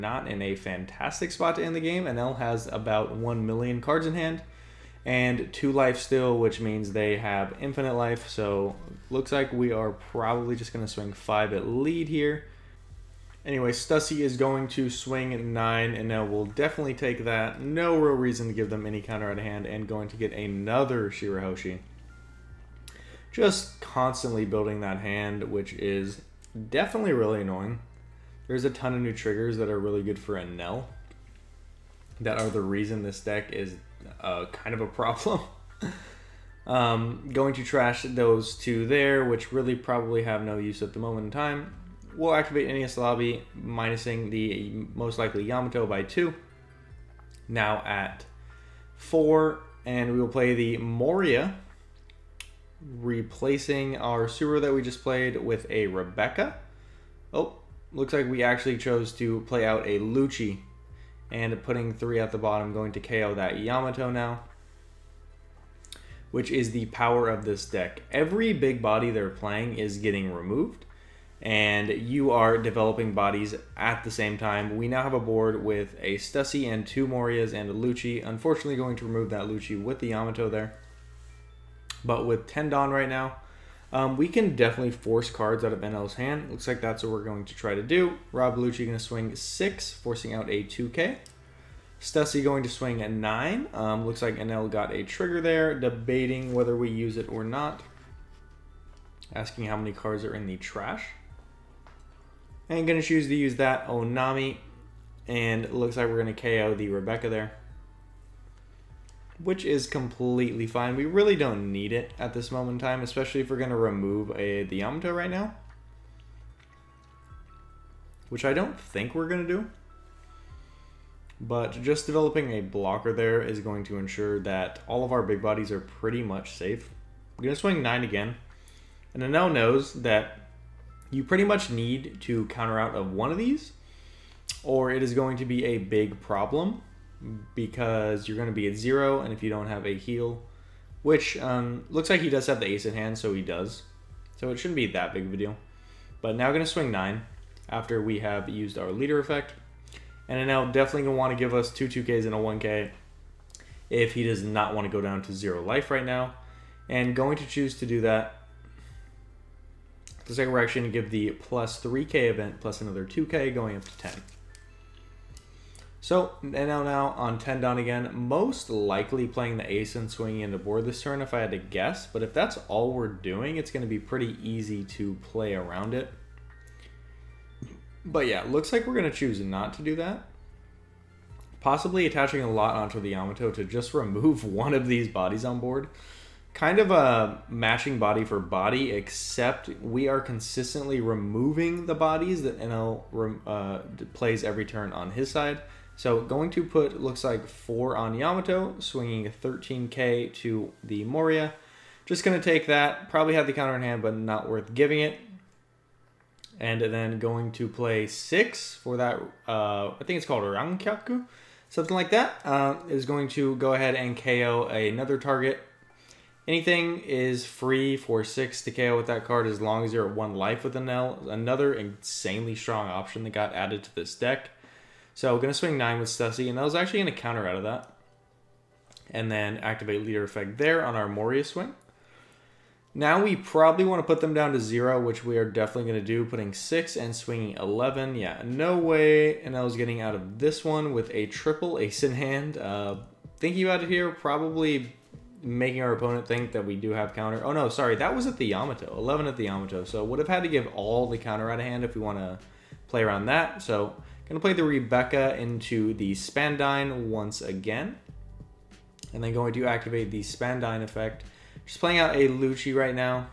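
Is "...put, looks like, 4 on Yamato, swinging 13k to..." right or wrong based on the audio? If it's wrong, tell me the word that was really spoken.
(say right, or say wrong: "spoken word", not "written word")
right.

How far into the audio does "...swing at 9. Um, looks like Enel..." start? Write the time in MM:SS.
01:32.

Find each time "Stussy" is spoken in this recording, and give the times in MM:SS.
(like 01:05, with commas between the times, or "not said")
00:13, 01:16, 01:31, 03:46.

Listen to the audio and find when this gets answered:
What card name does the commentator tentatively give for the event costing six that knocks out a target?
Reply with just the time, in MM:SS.
03:30.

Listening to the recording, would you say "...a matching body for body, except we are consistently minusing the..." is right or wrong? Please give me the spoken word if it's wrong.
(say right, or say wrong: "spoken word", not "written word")
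wrong: "removing", not "minusing".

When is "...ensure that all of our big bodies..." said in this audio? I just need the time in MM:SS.
02:03.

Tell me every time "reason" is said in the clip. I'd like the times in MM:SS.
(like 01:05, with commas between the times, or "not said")
00:18, 00:32.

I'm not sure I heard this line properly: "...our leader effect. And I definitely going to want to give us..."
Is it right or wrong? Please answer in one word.
right.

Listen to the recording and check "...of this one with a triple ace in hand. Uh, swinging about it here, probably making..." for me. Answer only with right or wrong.
wrong.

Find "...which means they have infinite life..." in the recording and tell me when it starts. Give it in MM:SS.
00:06.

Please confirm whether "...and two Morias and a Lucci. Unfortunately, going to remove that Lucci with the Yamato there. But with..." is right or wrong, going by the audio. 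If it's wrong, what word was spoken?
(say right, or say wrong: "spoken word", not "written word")
right.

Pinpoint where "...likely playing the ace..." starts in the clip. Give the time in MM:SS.
02:48.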